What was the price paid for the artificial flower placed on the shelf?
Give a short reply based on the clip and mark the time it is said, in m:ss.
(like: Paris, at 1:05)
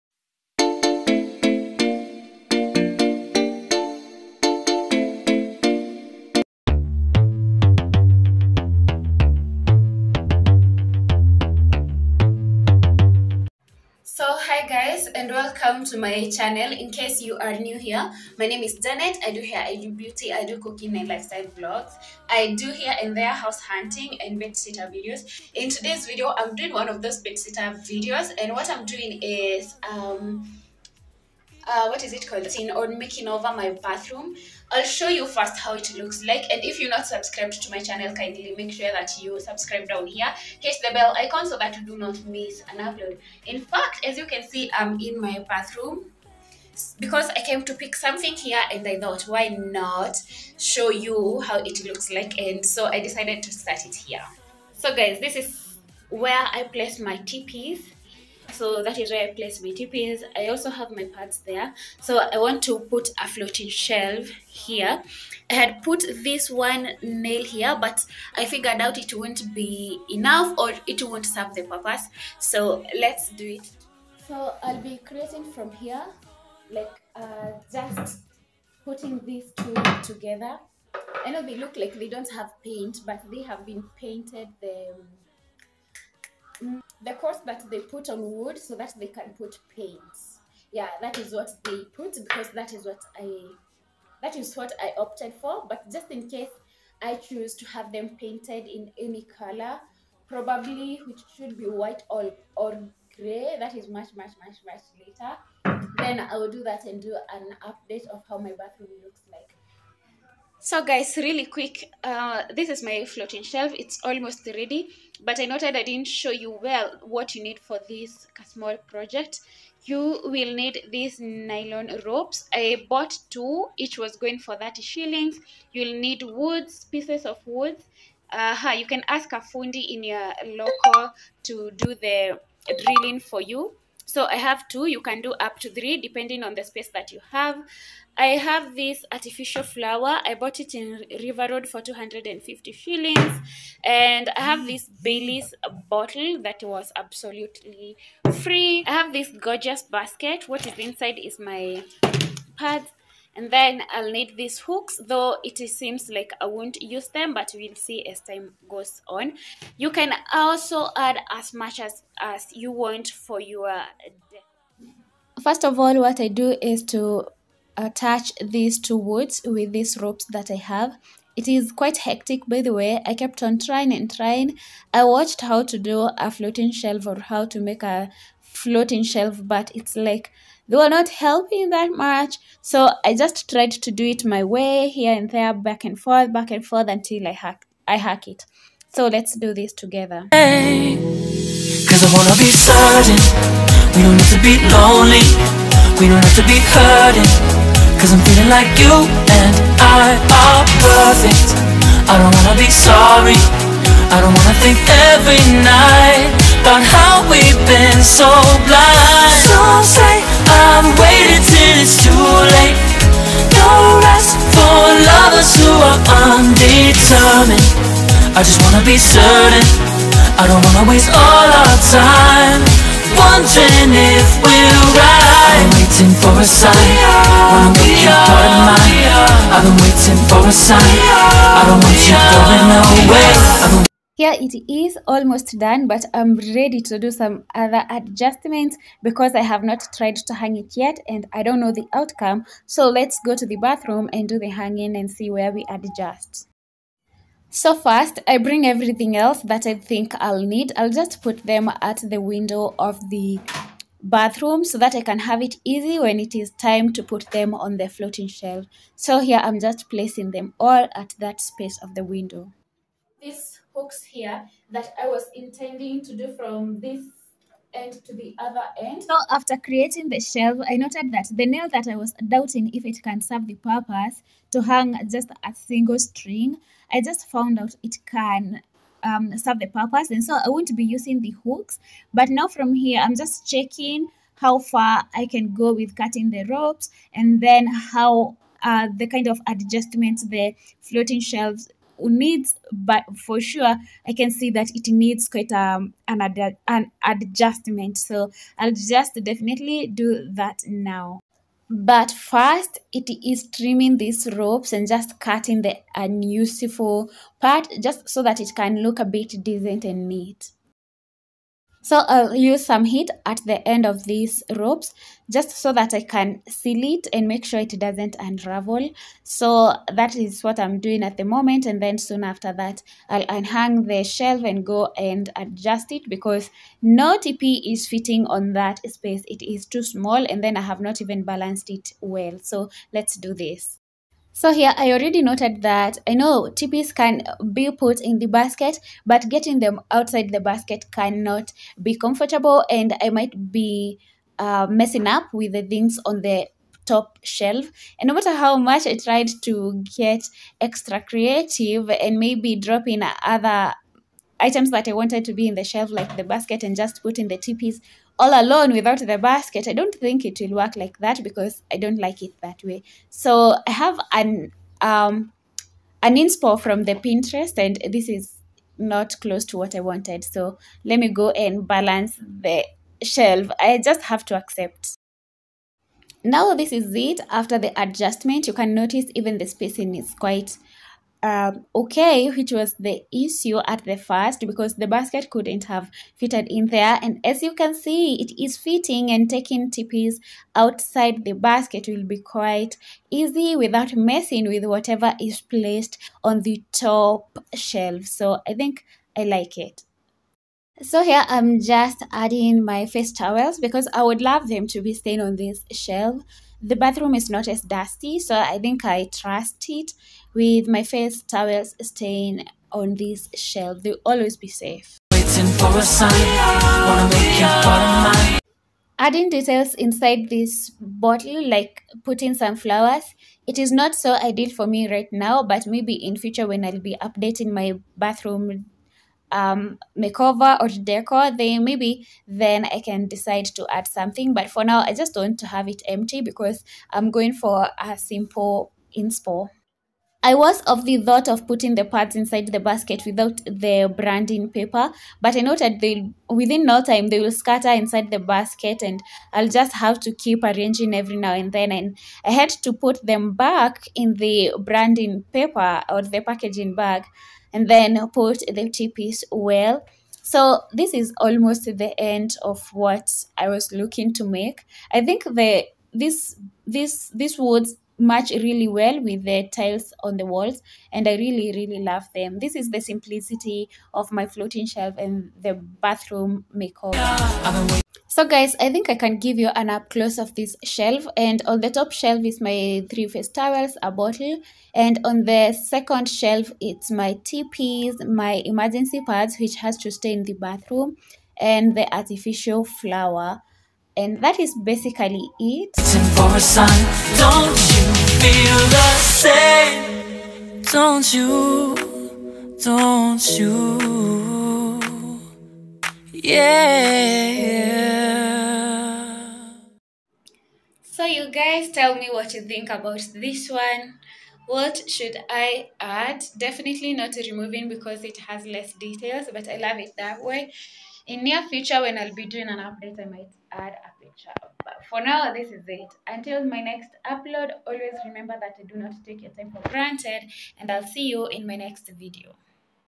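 250 shillings, at 2:21.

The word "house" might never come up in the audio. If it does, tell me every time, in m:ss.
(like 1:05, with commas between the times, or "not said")
0:23.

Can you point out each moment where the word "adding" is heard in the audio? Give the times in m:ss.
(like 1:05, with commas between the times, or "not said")
6:42, 6:58.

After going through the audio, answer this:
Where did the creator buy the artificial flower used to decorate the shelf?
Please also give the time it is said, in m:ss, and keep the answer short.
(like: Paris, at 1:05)
River Road, at 2:21.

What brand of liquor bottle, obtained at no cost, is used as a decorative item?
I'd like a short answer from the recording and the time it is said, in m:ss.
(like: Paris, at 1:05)
Bailey's, at 2:25.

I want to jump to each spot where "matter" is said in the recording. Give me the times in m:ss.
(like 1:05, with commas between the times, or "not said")
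5:48.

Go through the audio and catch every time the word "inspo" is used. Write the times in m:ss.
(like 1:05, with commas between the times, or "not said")
6:06, 7:18.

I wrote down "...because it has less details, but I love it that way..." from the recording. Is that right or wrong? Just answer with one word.
right.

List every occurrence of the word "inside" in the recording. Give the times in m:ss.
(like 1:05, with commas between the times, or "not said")
2:30, 6:59, 7:22, 7:27.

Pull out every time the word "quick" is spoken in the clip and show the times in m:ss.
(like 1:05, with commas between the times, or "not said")
1:51.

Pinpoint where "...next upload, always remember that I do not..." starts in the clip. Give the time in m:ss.
8:46.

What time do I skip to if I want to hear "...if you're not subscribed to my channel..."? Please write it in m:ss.
0:36.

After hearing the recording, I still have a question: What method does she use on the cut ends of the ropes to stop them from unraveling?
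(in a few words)
Heat.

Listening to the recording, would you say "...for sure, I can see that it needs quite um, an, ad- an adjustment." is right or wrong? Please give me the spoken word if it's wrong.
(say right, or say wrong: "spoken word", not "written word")
right.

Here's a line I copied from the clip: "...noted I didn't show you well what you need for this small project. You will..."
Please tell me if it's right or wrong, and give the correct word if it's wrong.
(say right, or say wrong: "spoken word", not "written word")
right.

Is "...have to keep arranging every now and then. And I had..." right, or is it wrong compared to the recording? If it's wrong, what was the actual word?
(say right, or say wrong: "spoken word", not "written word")
right.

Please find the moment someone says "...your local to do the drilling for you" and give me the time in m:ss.
2:10.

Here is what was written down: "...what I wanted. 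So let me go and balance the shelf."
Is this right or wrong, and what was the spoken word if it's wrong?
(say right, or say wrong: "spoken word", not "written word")
right.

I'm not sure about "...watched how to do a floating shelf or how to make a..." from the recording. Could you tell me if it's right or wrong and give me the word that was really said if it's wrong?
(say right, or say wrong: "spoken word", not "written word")
right.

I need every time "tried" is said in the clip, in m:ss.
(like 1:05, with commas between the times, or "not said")
3:03, 3:59, 5:48.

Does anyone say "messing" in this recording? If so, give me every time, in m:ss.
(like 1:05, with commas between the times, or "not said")
5:44, 6:33.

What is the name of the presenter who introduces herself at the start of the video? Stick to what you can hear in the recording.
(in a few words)
Janet.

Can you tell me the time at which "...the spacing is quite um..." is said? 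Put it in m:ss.
6:19.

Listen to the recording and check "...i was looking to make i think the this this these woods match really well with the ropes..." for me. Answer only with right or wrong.
wrong.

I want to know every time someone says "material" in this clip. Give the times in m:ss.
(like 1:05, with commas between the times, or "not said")
not said.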